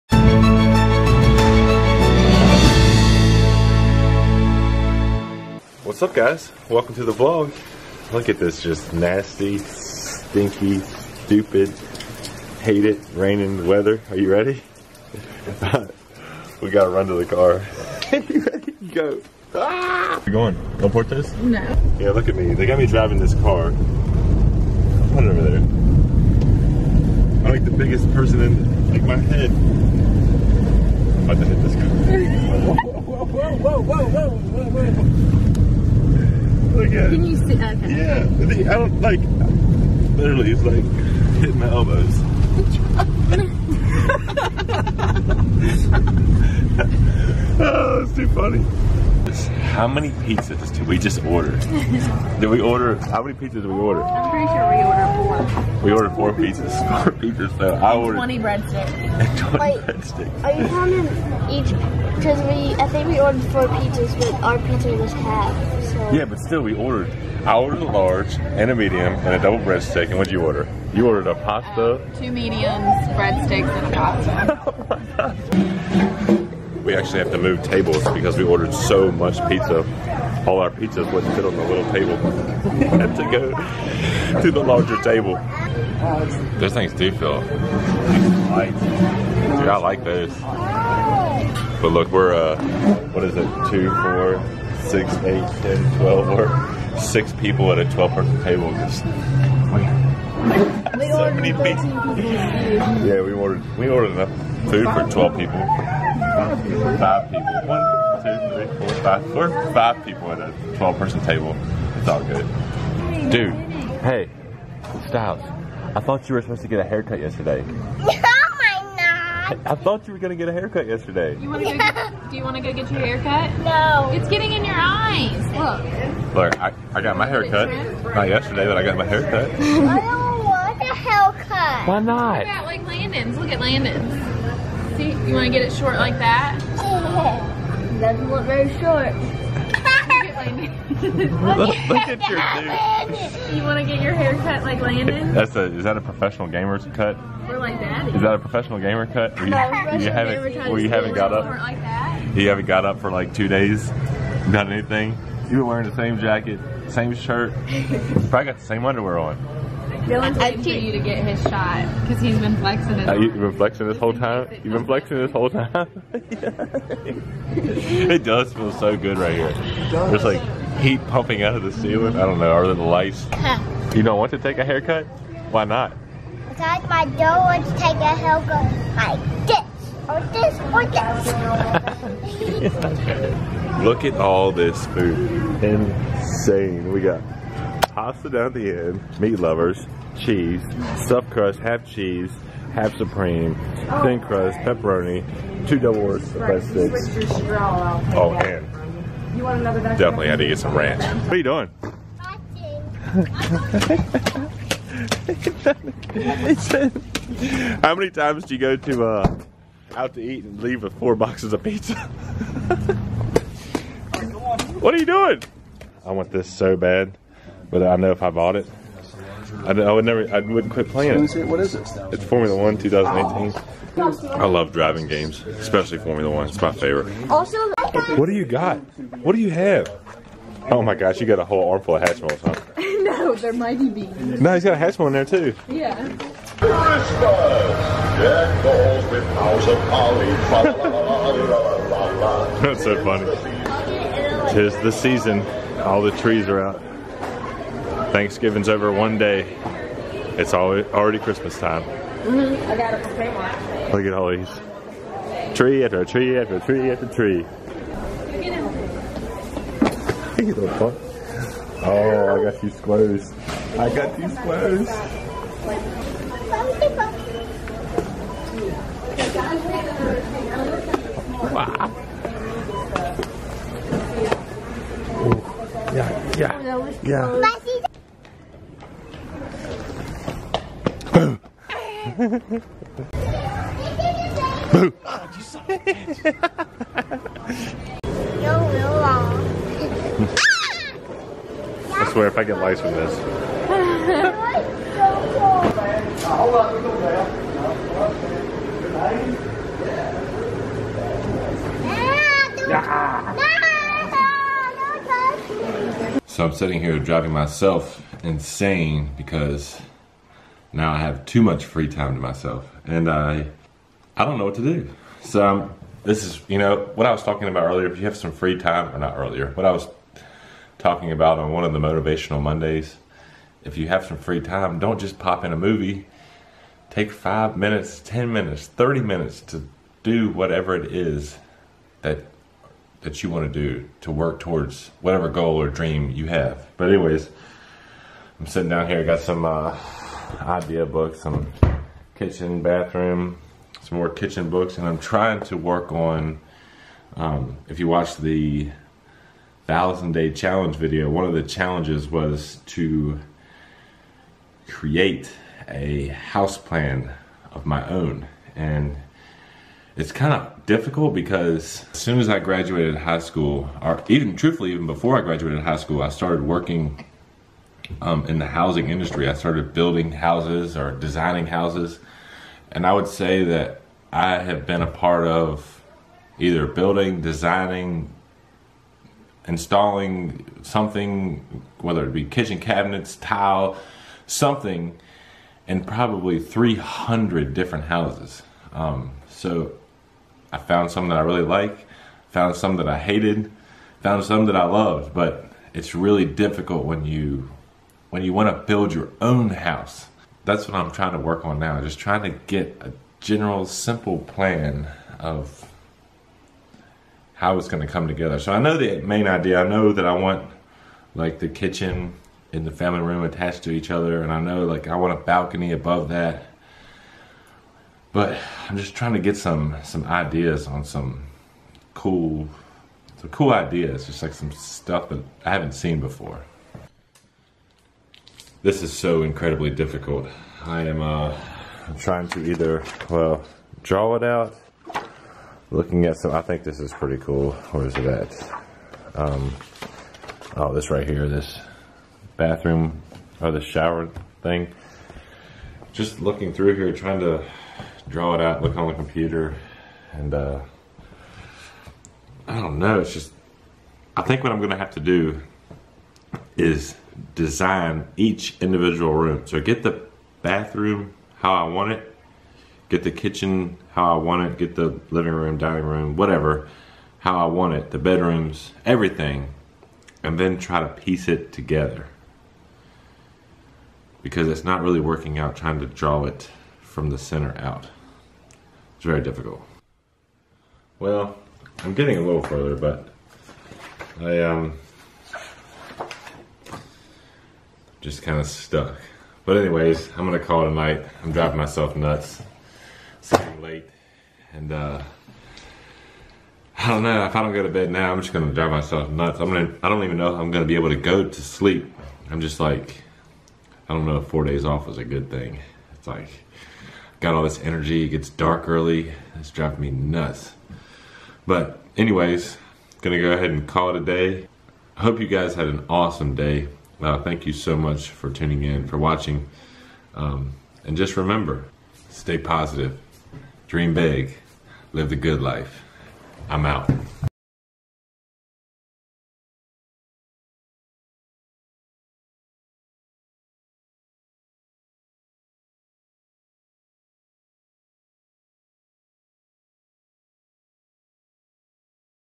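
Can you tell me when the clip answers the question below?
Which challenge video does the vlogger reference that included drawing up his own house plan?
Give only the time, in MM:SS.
05:49.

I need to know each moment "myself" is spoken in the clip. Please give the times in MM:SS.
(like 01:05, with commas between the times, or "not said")
05:07, 05:12, 08:11, 08:18.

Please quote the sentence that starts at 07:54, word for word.
Because it's not really working out trying to draw it from the center out.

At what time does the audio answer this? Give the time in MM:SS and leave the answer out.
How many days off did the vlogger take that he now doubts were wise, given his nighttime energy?
08:24.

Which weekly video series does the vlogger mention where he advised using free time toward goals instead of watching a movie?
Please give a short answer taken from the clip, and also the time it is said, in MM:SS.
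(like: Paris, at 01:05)
Motivational Mondays, at 05:21.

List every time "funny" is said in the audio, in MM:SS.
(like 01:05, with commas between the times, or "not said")
00:48, 04:03.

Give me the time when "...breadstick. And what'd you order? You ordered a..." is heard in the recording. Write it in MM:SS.
01:09.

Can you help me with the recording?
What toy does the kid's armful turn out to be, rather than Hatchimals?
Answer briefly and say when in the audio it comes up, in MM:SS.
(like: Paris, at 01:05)
Mighty Beans, at 03:53.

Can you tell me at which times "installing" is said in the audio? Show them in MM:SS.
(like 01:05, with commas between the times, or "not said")
06:19.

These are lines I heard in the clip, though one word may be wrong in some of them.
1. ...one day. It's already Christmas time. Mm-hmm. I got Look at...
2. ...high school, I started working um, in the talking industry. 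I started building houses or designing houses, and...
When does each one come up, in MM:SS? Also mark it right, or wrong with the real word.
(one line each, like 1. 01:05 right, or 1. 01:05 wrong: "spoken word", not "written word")
1. 04:08 right
2. 06:05 wrong: "housing", not "talking".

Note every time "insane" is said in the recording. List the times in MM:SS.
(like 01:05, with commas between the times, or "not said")
03:05, 05:08.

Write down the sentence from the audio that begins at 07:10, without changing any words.
I am uh, trying to either, well, draw it out, looking at some, I think this is pretty cool.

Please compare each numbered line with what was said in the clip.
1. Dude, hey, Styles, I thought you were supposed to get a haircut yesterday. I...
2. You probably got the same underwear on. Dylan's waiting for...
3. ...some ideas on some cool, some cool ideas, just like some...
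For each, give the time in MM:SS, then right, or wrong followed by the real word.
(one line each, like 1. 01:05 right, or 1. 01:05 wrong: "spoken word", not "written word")
1. 01:53 right
2. 02:37 right
3. 06:59 right.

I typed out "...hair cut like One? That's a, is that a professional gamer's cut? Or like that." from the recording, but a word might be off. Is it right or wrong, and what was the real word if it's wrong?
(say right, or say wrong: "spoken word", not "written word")
wrong: "Landon", not "One".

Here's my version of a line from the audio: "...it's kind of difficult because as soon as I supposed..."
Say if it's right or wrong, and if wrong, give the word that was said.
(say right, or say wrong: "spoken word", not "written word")
wrong: "graduated", not "supposed".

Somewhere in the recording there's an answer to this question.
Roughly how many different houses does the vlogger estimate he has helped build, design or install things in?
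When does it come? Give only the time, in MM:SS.
06:26.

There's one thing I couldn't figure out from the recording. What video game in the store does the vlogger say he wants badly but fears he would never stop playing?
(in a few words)
Formula One 2018.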